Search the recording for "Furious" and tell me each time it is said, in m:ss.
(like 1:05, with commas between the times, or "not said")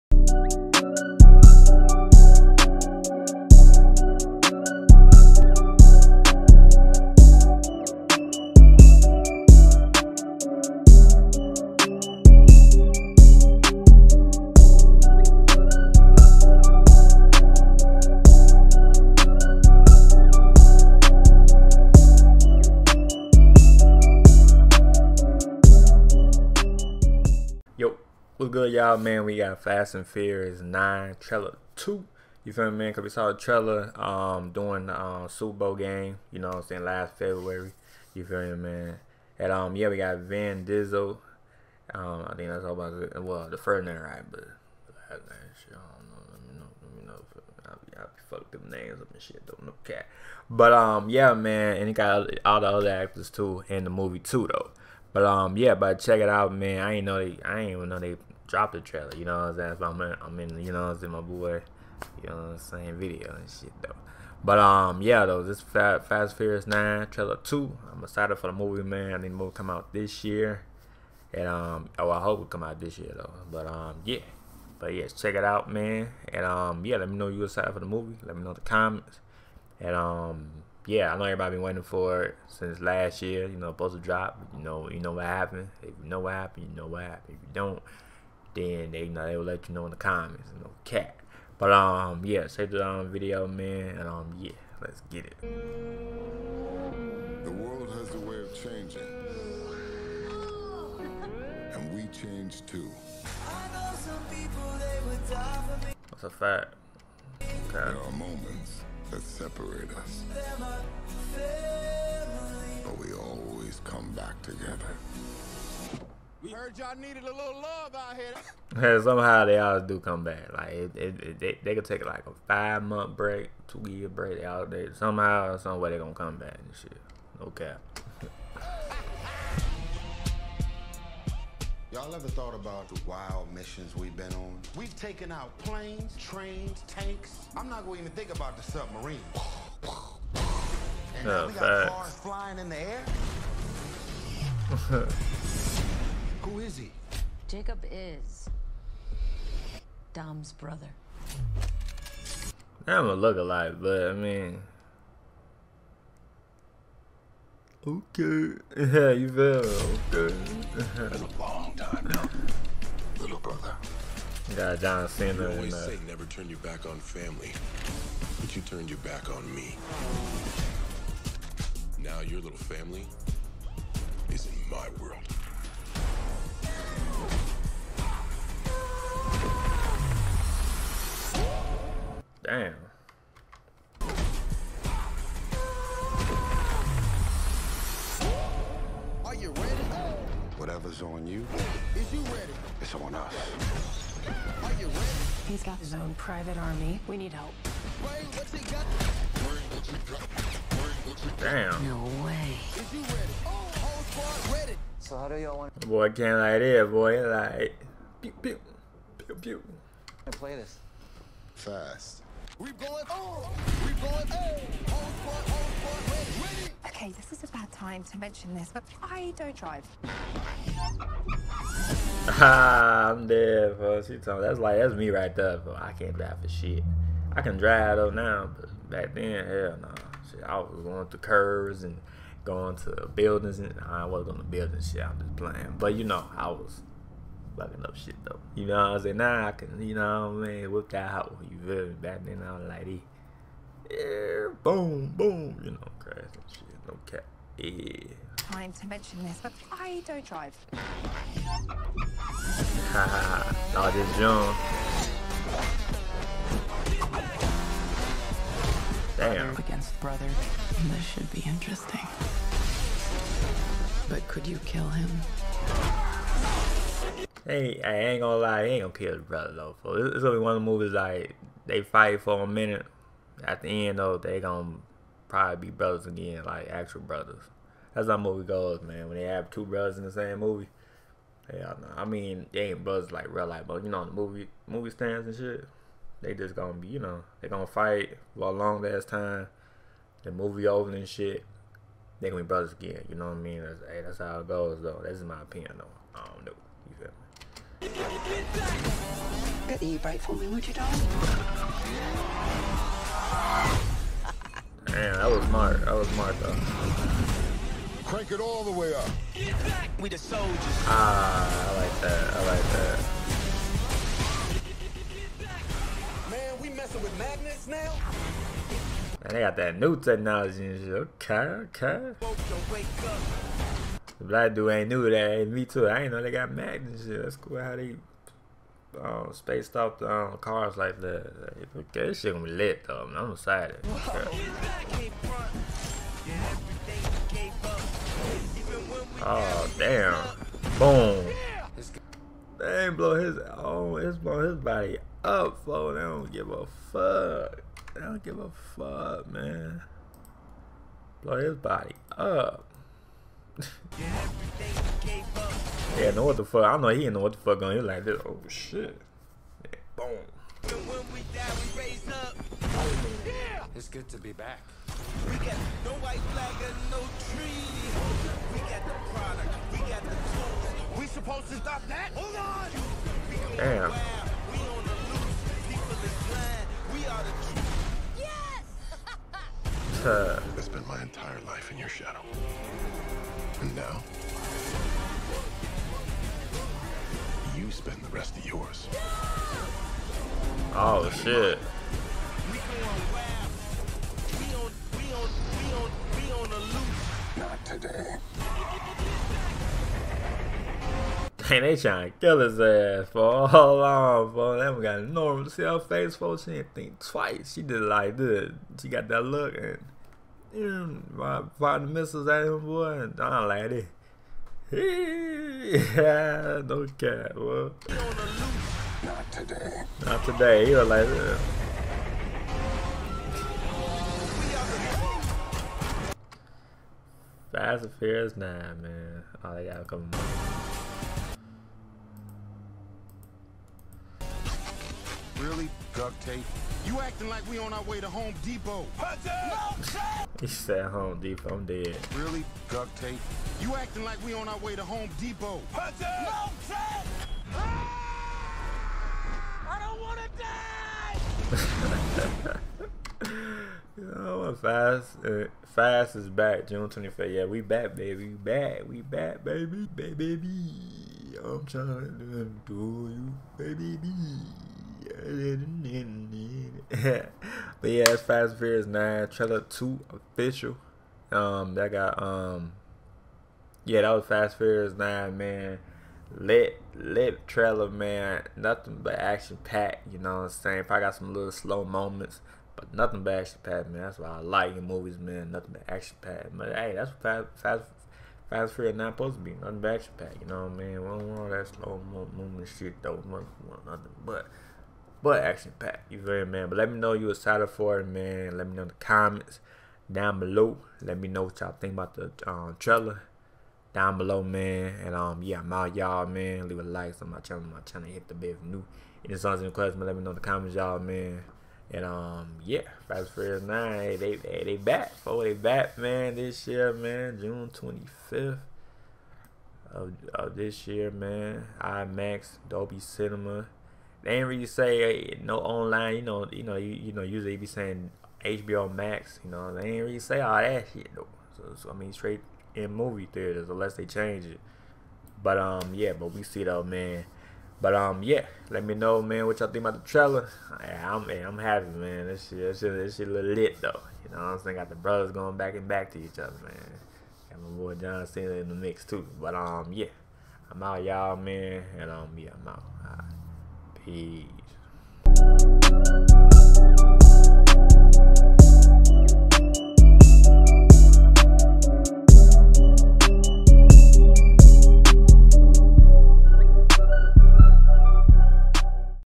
0:30, 1:06, 7:07, 7:48, 7:54, 8:08.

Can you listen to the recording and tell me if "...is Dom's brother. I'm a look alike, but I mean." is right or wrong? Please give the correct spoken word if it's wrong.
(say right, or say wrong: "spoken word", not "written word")
right.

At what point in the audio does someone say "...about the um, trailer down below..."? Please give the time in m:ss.
8:21.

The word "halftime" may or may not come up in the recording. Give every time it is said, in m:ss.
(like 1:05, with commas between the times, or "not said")
not said.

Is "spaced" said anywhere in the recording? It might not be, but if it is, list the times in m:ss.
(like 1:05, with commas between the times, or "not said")
5:29.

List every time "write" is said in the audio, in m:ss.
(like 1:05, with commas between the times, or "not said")
not said.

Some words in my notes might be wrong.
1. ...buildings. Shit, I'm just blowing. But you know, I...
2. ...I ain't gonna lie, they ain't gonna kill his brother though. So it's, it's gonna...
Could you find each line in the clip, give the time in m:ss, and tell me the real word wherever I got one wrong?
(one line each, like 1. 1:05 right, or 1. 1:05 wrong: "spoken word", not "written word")
1. 3:54 wrong: "playing", not "blowing"
2. 4:27 right.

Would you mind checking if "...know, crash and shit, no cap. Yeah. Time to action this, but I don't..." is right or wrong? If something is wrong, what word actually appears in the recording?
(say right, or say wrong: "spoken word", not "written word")
wrong: "mention", not "action".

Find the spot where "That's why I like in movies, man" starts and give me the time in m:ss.
8:04.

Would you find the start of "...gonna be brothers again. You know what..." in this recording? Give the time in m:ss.
4:52.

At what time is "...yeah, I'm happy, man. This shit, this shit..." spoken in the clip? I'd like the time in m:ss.
9:01.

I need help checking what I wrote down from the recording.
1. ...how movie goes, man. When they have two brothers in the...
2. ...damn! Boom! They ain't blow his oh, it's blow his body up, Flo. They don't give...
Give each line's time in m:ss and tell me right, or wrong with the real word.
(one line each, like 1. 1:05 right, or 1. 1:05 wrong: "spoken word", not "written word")
1. 4:38 right
2. 5:39 right.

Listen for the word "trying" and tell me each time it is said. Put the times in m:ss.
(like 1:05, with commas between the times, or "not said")
6:41, 7:41.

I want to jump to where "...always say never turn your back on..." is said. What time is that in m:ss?
2:45.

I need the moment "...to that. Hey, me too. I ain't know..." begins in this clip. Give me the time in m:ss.
5:25.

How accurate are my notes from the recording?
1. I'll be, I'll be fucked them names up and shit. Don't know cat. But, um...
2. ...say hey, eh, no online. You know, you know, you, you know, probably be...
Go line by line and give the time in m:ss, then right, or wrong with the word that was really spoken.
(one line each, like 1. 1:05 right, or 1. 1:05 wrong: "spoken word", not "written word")
1. 0:47 right
2. 8:44 wrong: "usually", not "probably".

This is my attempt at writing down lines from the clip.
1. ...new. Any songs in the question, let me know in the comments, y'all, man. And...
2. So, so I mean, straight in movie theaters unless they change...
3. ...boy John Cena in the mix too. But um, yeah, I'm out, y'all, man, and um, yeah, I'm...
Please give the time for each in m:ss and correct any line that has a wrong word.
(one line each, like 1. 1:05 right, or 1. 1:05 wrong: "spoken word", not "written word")
1. 8:28 right
2. 8:51 right
3. 9:07 right.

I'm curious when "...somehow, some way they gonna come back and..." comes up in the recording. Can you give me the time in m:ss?
2:04.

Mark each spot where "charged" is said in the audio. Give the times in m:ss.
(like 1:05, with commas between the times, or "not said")
not said.